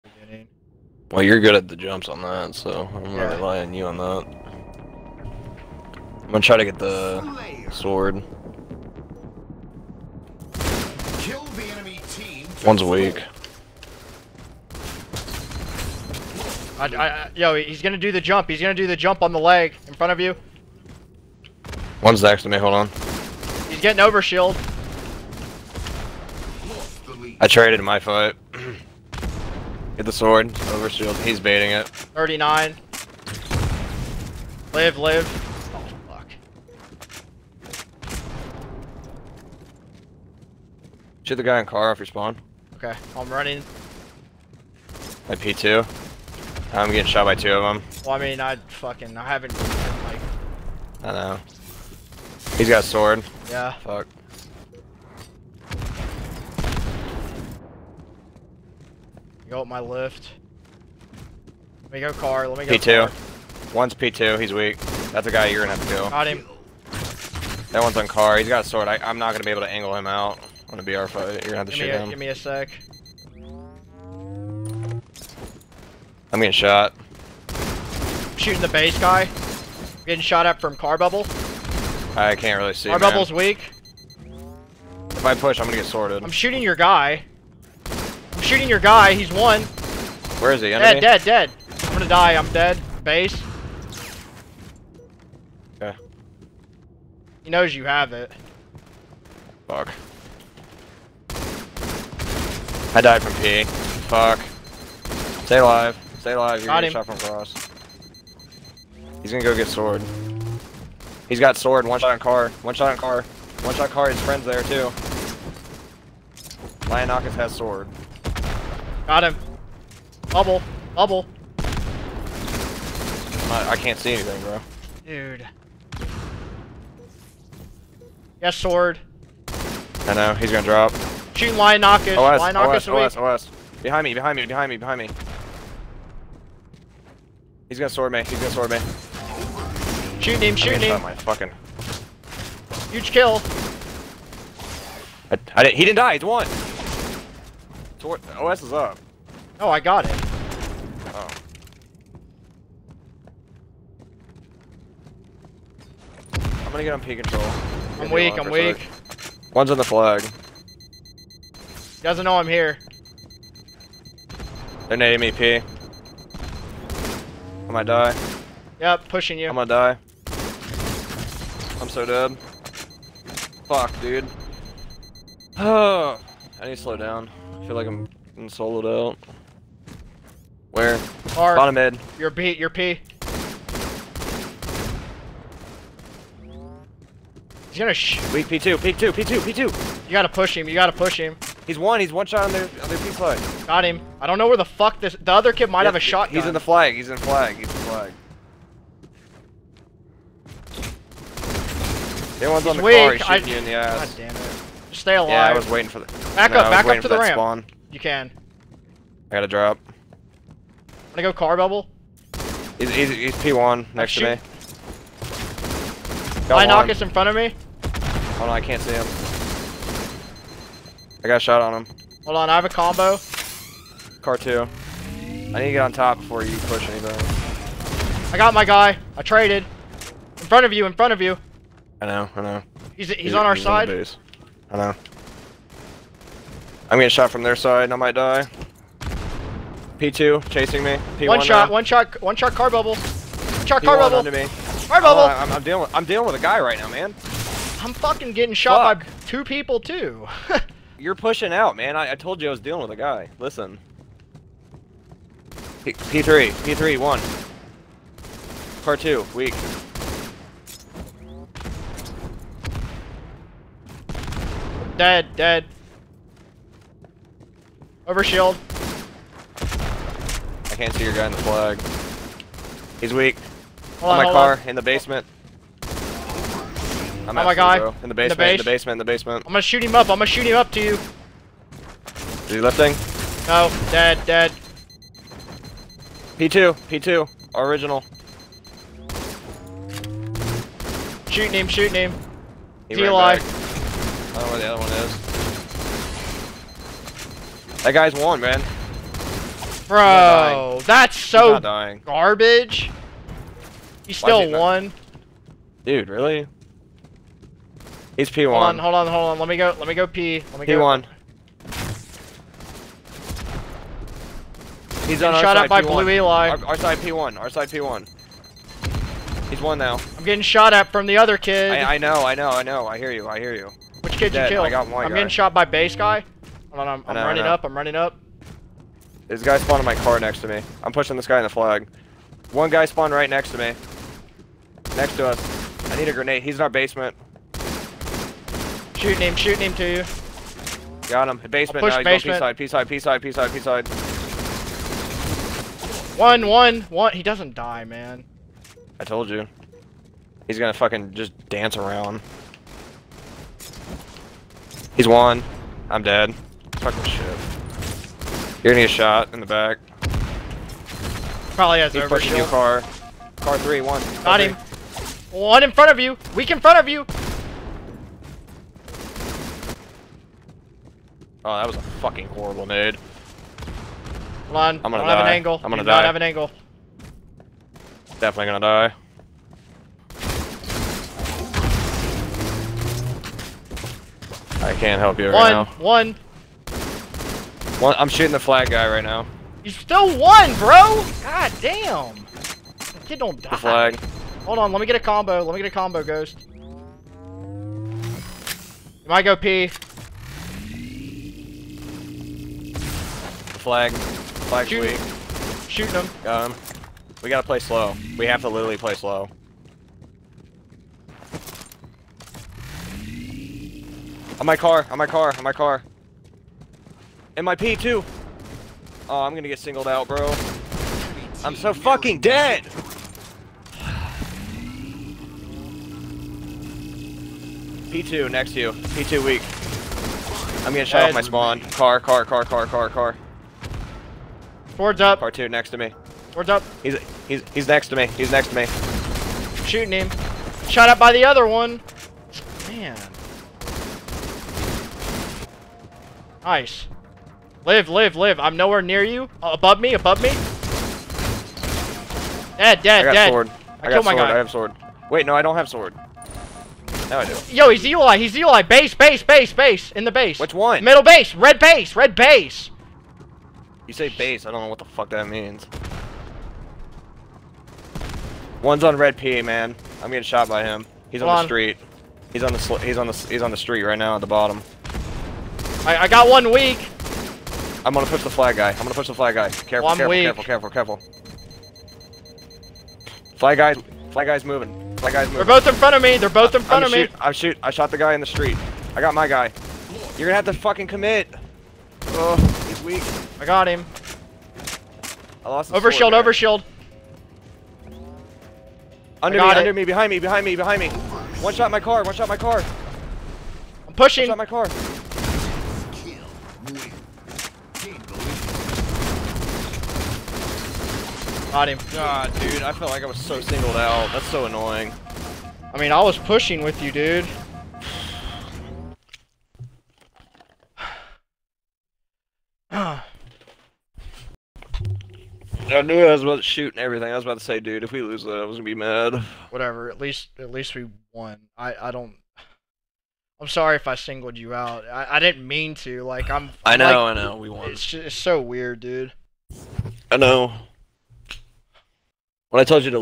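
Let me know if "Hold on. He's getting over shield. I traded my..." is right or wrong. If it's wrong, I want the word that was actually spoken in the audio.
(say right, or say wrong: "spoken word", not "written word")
right.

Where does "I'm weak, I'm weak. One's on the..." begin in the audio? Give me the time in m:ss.
2:37.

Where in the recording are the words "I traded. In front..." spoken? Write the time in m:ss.
3:49.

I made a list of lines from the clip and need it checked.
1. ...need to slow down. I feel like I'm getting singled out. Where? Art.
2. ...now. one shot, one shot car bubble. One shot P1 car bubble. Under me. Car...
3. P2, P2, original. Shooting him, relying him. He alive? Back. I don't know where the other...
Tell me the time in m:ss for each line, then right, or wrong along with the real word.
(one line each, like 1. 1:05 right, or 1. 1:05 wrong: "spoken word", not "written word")
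1. 2:56 wrong: "soloed", not "singled"
2. 4:01 right
3. 4:46 wrong: "shooting", not "relying".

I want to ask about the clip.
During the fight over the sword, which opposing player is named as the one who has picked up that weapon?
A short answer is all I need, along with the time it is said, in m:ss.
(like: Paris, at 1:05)
Lionakis, at 1:56.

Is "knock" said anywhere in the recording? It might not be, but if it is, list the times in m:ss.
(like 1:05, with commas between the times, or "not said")
2:11, 3:36.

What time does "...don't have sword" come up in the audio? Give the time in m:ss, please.
7:35.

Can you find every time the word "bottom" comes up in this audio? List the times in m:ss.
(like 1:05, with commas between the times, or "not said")
3:01, 7:54.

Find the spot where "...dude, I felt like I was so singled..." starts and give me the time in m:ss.
8:32.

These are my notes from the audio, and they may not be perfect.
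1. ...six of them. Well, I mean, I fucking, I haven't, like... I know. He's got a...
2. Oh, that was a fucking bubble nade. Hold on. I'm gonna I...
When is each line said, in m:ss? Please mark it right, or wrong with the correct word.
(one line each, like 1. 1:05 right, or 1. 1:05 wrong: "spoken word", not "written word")
1. 0:47 wrong: "two", not "six"
2. 6:11 wrong: "horrible", not "bubble".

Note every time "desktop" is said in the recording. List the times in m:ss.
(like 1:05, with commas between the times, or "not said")
not said.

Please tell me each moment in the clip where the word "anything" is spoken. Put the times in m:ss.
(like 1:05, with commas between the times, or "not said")
2:04, 3:46.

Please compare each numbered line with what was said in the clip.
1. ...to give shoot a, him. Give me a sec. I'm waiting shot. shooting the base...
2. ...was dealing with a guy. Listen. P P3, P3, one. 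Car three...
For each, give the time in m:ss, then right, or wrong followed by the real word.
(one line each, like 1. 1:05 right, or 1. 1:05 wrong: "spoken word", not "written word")
1. 1:11 wrong: "getting", not "waiting"
2. 4:12 wrong: "two", not "three".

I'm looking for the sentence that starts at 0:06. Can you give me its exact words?
I'm gonna try to get the sword.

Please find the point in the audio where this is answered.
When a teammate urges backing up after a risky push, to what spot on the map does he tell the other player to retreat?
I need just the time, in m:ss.
3:27.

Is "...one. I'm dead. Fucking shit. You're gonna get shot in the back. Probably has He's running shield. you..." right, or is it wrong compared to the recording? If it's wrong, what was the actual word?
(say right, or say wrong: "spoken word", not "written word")
wrong: "pushing", not "running".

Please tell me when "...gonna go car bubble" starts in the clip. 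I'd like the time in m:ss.
3:31.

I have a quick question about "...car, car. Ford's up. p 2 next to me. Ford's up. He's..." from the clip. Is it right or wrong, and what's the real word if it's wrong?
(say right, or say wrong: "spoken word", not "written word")
right.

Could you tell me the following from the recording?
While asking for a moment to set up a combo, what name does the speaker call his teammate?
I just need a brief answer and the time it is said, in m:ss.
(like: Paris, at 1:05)
Ghost, at 6:36.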